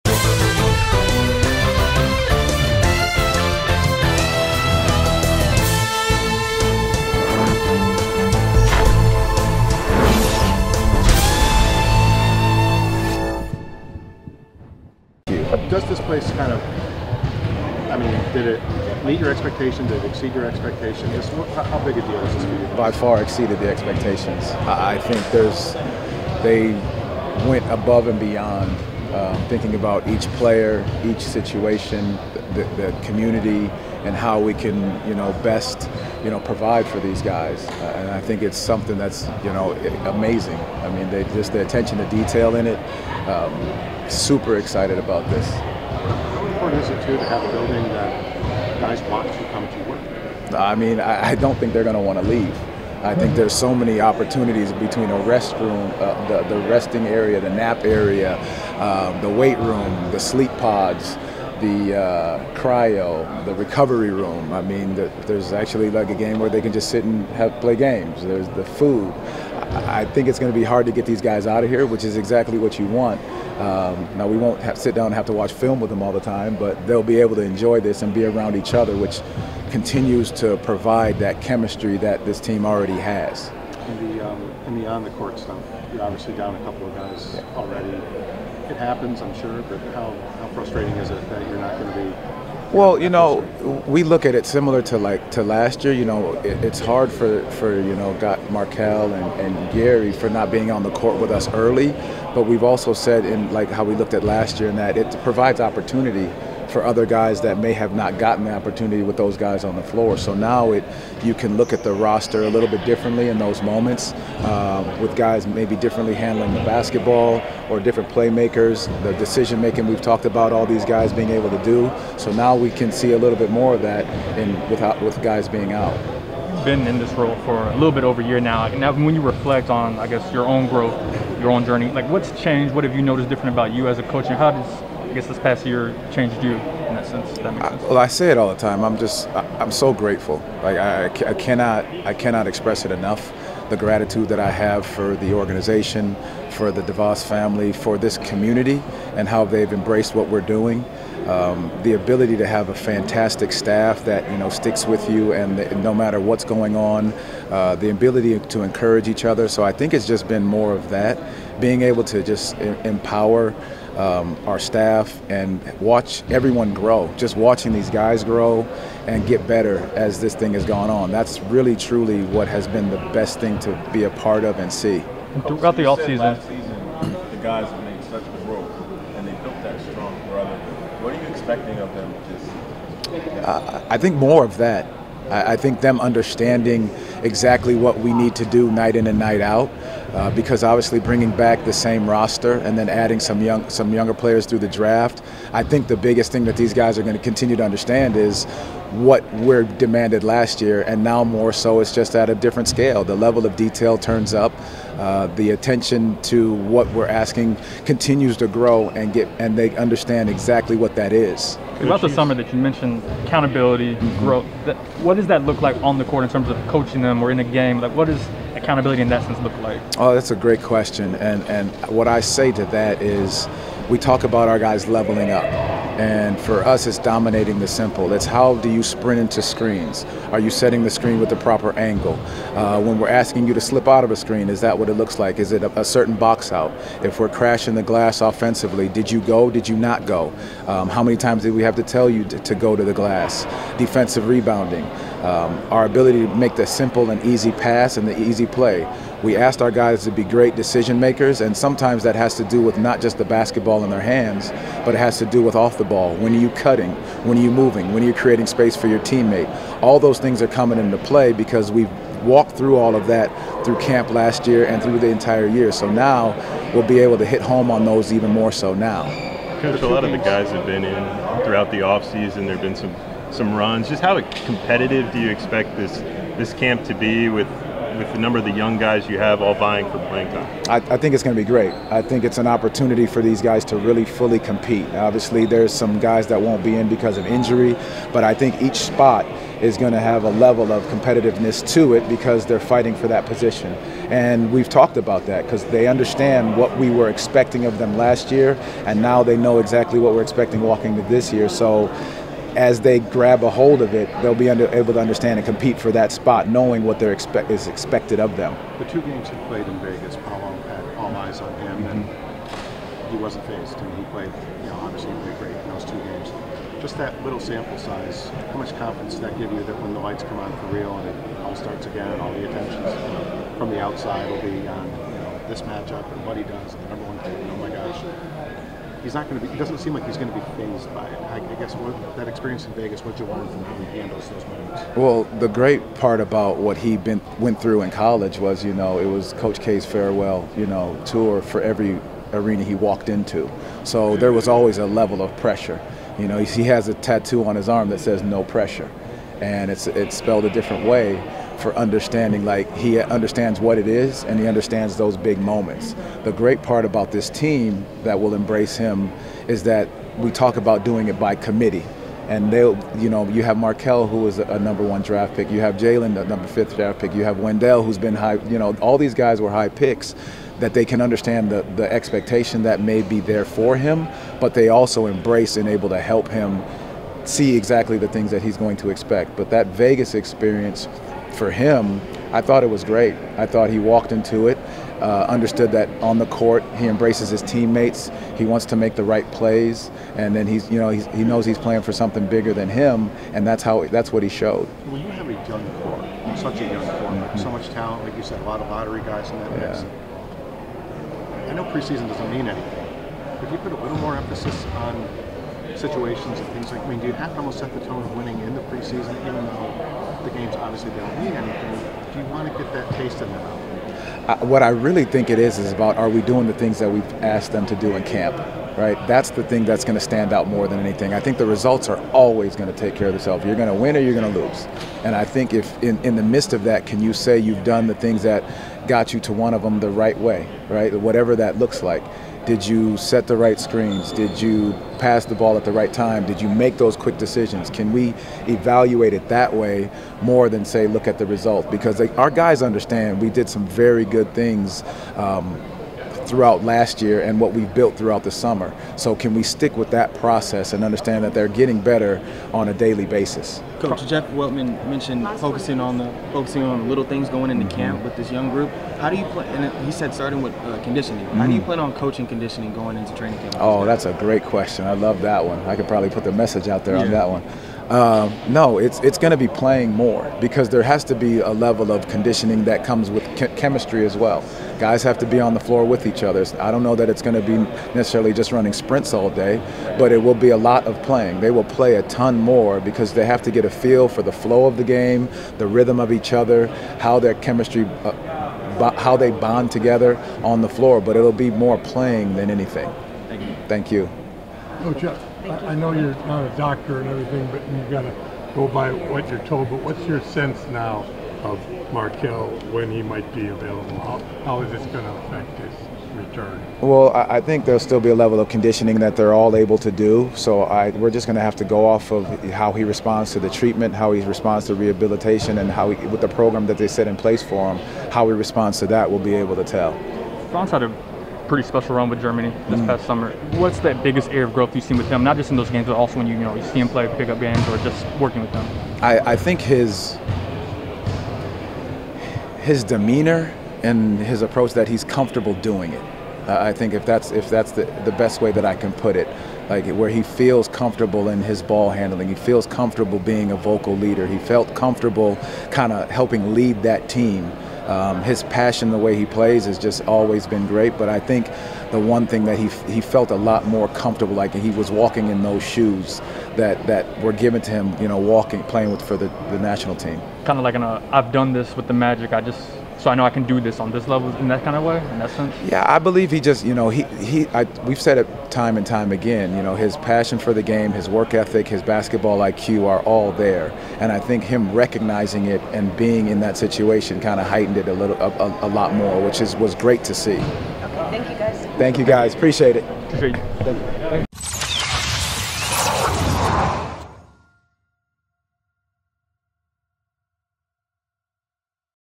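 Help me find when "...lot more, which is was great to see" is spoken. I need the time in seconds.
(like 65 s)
578 s.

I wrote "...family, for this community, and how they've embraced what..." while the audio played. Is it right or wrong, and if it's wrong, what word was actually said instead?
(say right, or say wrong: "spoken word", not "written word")
right.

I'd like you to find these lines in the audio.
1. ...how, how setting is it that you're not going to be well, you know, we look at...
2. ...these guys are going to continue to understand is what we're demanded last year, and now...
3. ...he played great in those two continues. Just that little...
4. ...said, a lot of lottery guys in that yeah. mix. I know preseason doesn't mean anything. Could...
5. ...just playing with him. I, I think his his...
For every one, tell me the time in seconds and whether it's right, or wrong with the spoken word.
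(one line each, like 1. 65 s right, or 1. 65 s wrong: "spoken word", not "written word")
1. 89 s wrong: "frustrating", not "setting"
2. 196 s right
3. 315 s wrong: "games", not "continues"
4. 398 s right
5. 527 s wrong: "working", not "playing".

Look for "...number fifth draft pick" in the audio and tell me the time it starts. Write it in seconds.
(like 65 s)
366 s.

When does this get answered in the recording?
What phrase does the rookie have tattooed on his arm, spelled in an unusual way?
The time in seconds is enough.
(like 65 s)
348 s.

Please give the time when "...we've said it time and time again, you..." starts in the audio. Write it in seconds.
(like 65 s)
567 s.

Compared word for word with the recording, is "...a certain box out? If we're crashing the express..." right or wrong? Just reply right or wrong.
wrong.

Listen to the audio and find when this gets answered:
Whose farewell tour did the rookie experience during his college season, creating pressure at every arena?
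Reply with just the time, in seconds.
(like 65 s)
339 s.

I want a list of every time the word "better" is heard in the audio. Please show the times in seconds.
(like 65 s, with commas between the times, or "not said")
169 s, 451 s.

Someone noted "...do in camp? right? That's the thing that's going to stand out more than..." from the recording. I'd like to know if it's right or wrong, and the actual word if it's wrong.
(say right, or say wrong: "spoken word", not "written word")
right.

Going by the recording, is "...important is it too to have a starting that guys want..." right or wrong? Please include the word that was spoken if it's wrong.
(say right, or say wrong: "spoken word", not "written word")
wrong: "building", not "starting".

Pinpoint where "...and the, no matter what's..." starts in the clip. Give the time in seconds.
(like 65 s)
155 s.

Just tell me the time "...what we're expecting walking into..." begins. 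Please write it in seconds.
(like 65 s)
299 s.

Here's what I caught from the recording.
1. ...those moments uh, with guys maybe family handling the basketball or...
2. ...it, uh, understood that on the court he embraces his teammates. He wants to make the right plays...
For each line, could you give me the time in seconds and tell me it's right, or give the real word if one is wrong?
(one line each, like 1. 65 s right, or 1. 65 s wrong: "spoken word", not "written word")
1. 113 s wrong: "differently", not "family"
2. 384 s right.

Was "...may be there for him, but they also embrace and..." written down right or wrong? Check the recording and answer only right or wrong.
right.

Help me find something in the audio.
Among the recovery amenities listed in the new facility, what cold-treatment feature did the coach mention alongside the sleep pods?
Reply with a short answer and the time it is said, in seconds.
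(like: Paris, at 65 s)
cryo, at 62 s.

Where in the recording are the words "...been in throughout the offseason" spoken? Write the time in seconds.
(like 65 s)
270 s.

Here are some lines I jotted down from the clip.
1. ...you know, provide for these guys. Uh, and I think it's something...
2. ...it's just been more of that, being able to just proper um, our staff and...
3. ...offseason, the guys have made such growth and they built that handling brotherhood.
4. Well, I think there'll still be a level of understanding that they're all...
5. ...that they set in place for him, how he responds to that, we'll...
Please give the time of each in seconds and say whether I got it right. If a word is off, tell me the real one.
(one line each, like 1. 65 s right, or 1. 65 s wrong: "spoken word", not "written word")
1. 36 s right
2. 159 s wrong: "empower", not "proper"
3. 175 s wrong: "strong", not "handling"
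4. 506 s wrong: "conditioning", not "understanding"
5. 516 s right.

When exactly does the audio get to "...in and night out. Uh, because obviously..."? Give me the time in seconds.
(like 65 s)
188 s.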